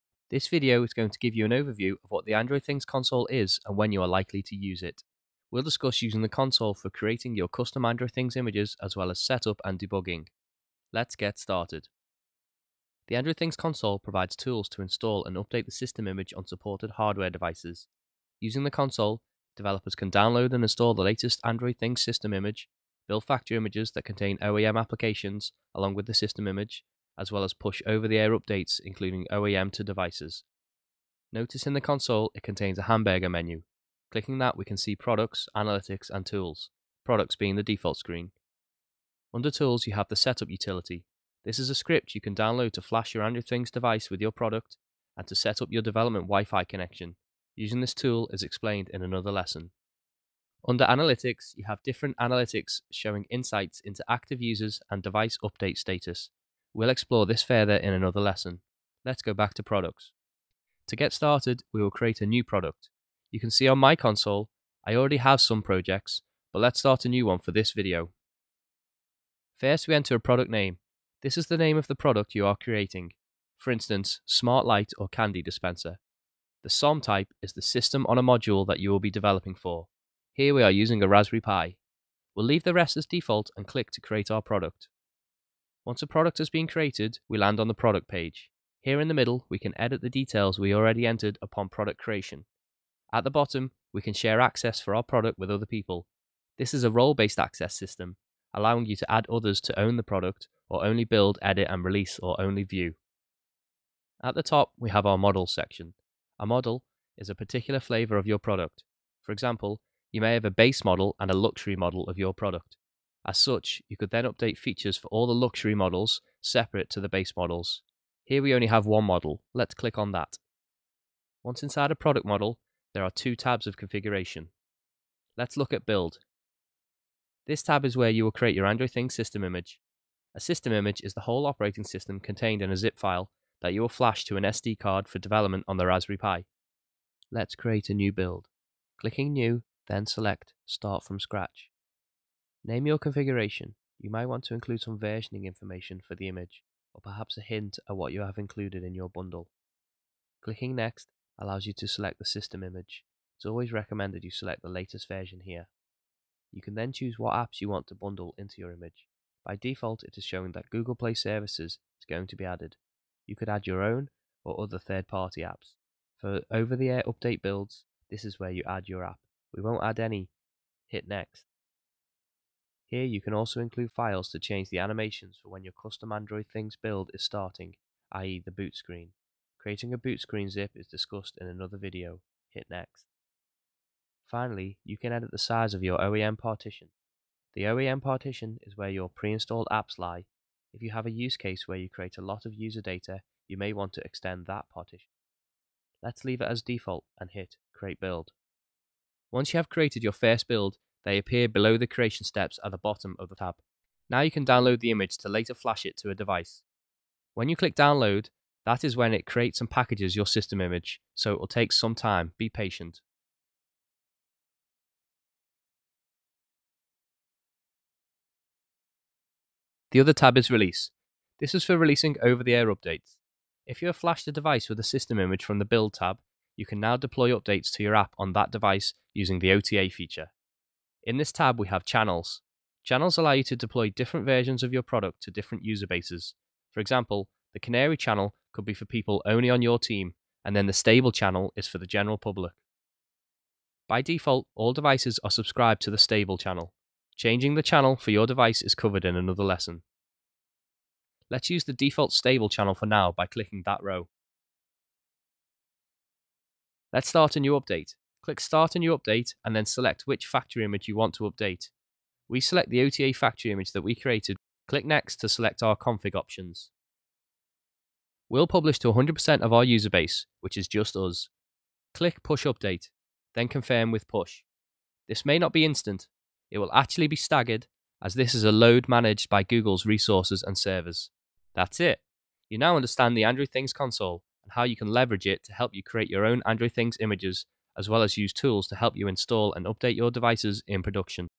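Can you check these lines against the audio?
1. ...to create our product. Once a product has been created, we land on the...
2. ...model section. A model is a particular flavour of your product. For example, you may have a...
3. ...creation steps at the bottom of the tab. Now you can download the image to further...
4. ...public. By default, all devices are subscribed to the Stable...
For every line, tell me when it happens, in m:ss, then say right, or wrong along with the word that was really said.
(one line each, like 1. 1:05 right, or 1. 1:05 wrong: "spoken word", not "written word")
1. 1:23 right
2. 1:45 right
3. 3:21 wrong: "later", not "further"
4. 4:02 right.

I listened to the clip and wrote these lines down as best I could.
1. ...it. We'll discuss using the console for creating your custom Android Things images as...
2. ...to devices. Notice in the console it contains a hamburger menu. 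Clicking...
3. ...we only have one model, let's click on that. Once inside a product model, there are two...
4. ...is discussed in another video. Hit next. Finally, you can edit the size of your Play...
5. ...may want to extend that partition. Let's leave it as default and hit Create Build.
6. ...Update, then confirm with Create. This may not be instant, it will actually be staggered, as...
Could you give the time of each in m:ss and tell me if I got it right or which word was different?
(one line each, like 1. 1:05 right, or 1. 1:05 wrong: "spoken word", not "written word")
1. 0:04 right
2. 0:29 right
3. 1:58 right
4. 3:00 wrong: "OEM", not "Play"
5. 3:13 right
6. 4:32 wrong: "Push", not "Create".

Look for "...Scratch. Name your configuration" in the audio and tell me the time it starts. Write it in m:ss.
2:21.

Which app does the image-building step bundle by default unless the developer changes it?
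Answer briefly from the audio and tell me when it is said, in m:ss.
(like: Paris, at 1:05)
Google Play Services, at 2:40.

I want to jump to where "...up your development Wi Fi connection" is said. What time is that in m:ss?
0:45.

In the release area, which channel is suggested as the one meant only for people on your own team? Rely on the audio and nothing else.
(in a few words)
Canary.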